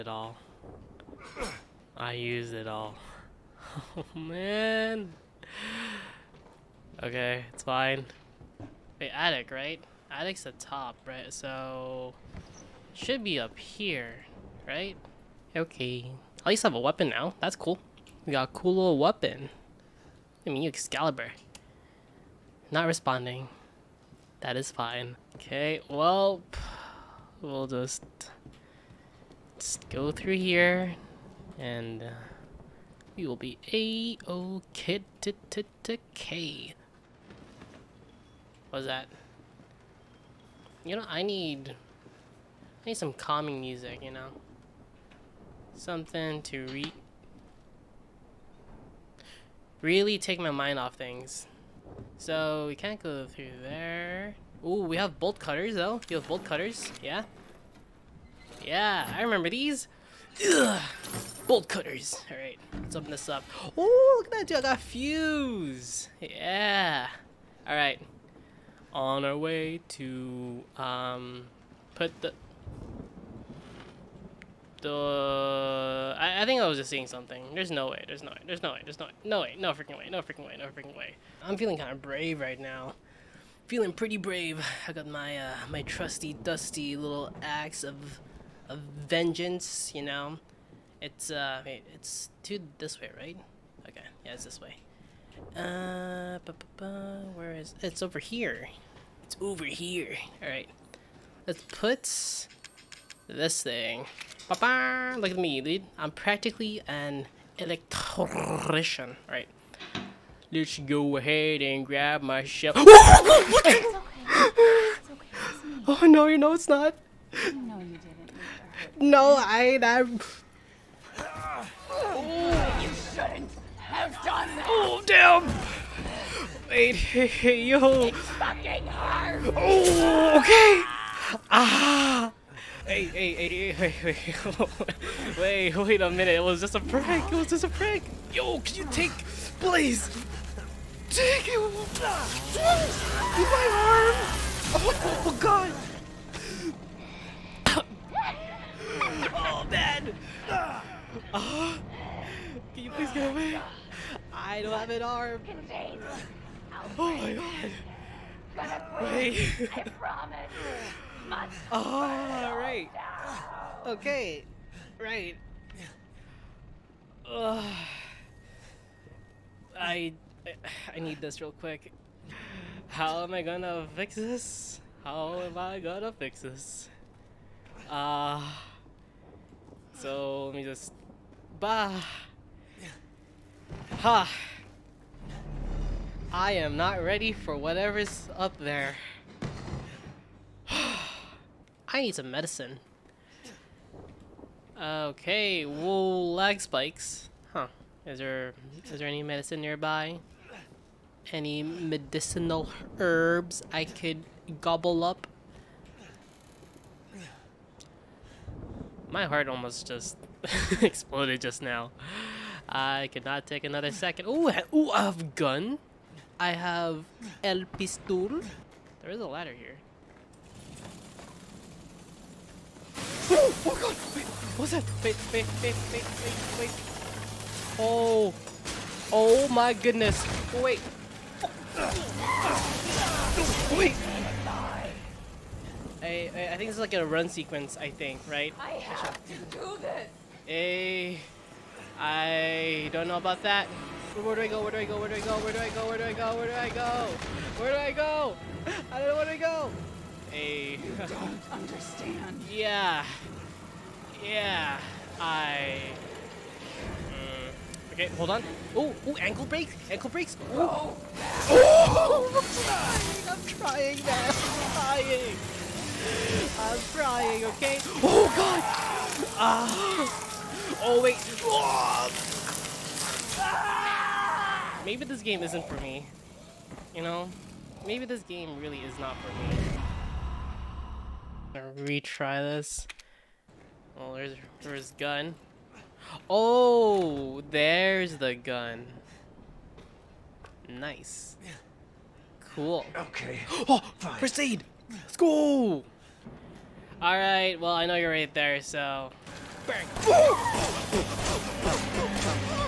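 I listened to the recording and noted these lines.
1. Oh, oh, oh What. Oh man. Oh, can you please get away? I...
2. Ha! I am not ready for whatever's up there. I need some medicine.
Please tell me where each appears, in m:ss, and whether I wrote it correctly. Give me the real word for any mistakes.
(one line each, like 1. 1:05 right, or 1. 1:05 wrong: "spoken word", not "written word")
1. 2:24 wrong: "God", not "What"
2. 3:03 right.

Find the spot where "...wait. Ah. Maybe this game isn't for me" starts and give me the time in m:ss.
4:31.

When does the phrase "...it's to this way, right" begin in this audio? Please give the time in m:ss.
1:31.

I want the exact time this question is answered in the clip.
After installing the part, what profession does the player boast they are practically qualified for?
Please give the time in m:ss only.
1:47.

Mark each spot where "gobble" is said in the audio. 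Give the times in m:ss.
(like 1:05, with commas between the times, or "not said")
3:24.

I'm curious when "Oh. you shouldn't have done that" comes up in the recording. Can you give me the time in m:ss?
2:01.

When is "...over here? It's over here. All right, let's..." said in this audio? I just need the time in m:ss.
1:38.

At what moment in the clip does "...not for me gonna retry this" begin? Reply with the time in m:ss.
4:38.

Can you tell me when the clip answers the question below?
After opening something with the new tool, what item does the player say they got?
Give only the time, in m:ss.
1:04.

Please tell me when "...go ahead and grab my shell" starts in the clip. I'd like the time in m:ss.
1:50.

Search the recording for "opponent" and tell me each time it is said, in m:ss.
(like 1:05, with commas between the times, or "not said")
not said.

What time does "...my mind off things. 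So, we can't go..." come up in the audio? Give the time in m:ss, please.
0:50.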